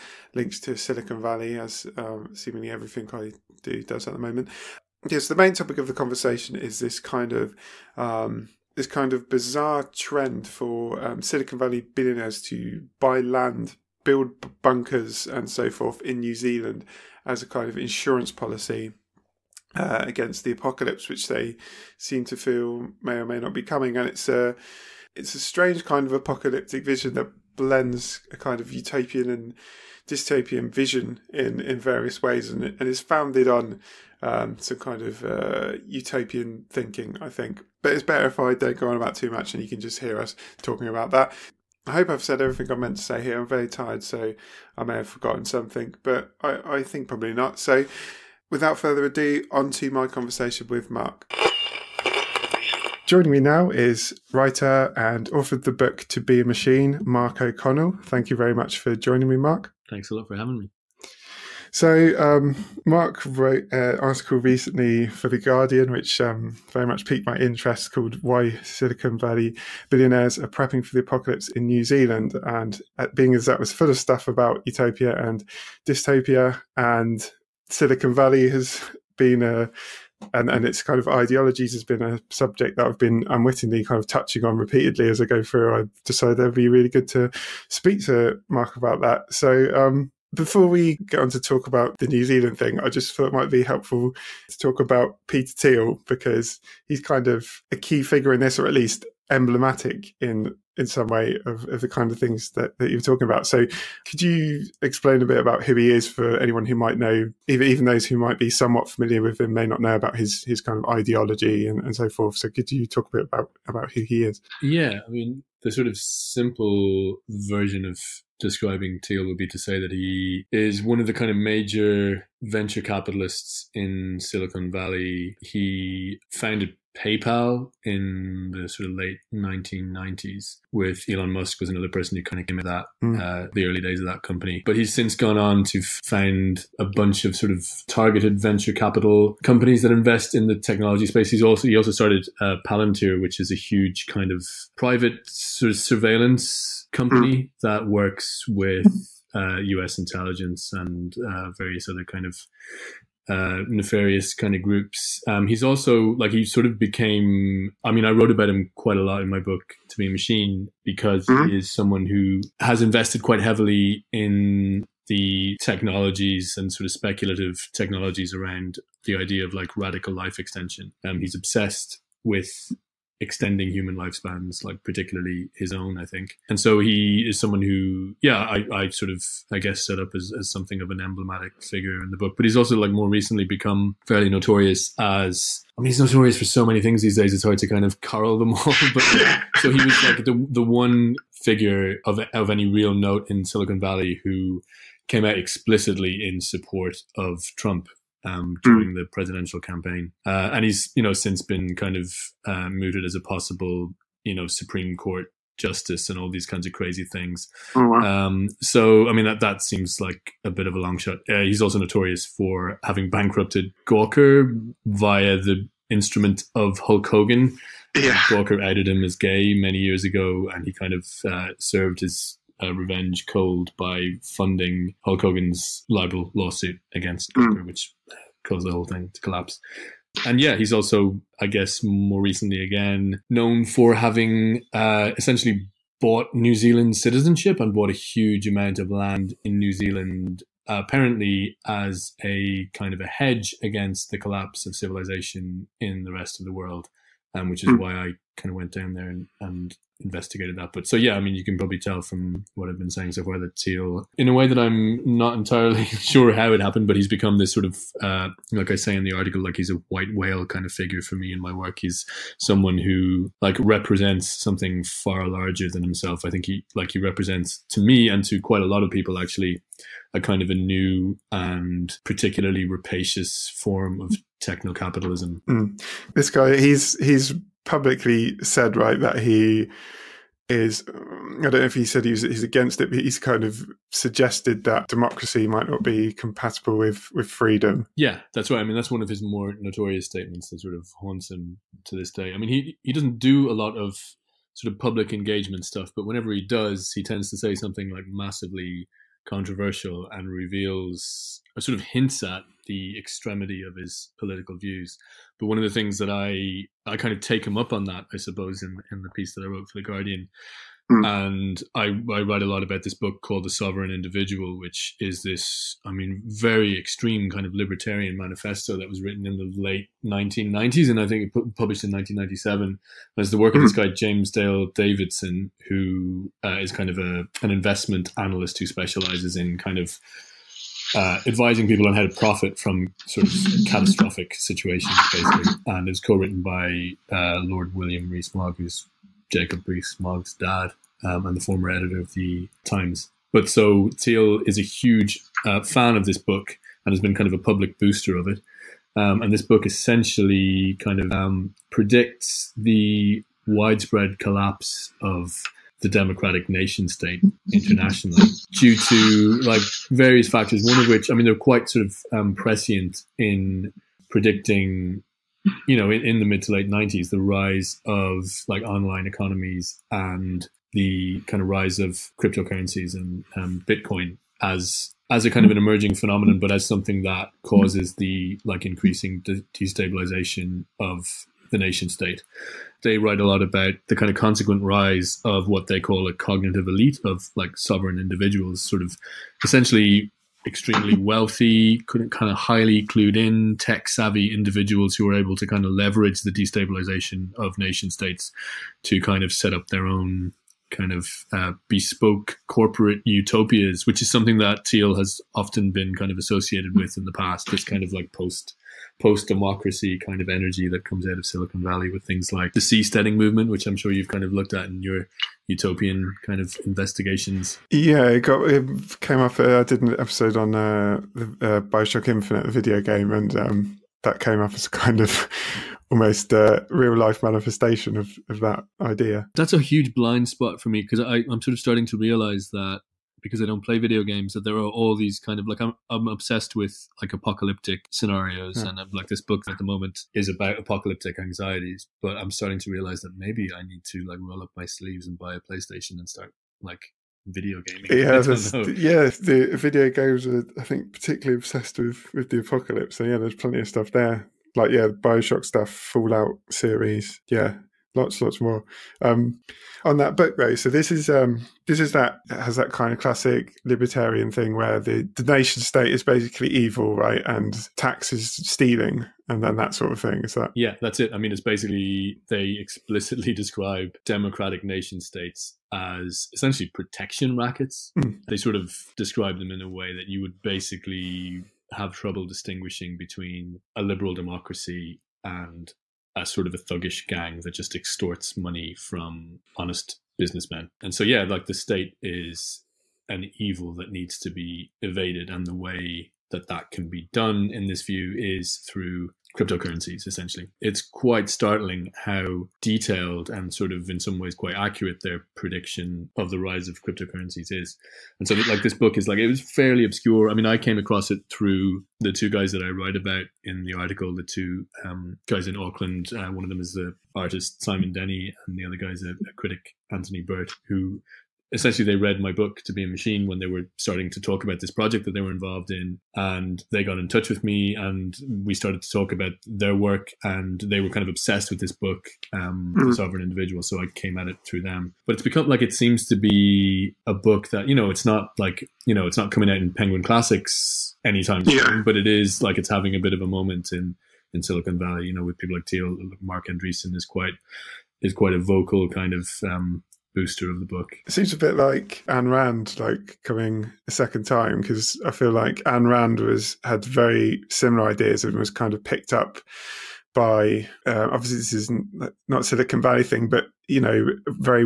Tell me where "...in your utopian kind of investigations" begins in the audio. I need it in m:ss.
6:54.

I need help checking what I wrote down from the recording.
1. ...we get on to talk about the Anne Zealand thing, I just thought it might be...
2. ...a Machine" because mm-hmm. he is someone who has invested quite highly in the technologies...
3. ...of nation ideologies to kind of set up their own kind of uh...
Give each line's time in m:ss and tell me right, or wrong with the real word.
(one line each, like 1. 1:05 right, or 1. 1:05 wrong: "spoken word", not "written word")
1. 1:30 wrong: "New", not "Anne"
2. 2:40 wrong: "heavily", not "highly"
3. 6:37 wrong: "states", not "ideologies".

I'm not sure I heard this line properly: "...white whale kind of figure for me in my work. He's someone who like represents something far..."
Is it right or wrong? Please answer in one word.
right.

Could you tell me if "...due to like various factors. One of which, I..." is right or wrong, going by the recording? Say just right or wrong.
right.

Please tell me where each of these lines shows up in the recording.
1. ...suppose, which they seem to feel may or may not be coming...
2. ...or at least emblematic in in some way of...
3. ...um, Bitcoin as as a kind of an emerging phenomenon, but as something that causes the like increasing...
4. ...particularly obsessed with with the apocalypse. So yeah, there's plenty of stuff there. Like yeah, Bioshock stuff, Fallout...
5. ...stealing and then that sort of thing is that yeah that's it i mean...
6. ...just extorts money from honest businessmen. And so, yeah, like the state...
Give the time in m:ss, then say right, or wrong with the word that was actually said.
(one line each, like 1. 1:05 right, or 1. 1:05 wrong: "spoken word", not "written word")
1. 0:20 wrong: "apocalypse", not "suppose"
2. 1:38 right
3. 6:13 right
4. 7:30 right
5. 7:48 right
6. 8:07 right.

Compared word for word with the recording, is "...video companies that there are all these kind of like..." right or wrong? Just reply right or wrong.
wrong.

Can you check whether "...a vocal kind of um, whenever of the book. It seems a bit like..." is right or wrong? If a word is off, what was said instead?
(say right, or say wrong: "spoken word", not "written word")
wrong: "booster", not "whenever".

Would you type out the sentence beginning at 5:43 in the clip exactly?
But so Thiel is a huge uh, fan of this book and has been kind of a public booster of it.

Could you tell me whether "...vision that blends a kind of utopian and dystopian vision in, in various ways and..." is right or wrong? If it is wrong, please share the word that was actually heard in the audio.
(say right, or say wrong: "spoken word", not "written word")
right.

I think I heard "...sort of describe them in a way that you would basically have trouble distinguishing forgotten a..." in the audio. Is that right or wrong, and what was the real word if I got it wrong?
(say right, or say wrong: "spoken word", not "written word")
wrong: "between", not "forgotten".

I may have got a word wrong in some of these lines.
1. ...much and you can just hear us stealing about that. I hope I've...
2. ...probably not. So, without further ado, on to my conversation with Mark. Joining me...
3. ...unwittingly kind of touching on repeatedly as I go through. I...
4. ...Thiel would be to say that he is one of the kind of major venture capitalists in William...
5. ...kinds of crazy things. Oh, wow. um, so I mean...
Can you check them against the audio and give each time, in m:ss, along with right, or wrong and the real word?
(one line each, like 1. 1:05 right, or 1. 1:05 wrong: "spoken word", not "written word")
1. 0:39 wrong: "talking", not "stealing"
2. 0:47 right
3. 1:23 right
4. 1:59 wrong: "Silicon", not "William"
5. 3:26 right.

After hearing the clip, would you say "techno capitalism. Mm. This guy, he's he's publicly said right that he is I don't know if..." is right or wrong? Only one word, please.
right.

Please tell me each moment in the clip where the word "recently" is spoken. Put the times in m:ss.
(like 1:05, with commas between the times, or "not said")
1:04, 3:03, 3:52.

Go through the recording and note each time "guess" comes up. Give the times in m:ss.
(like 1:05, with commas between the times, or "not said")
2:59, 3:51.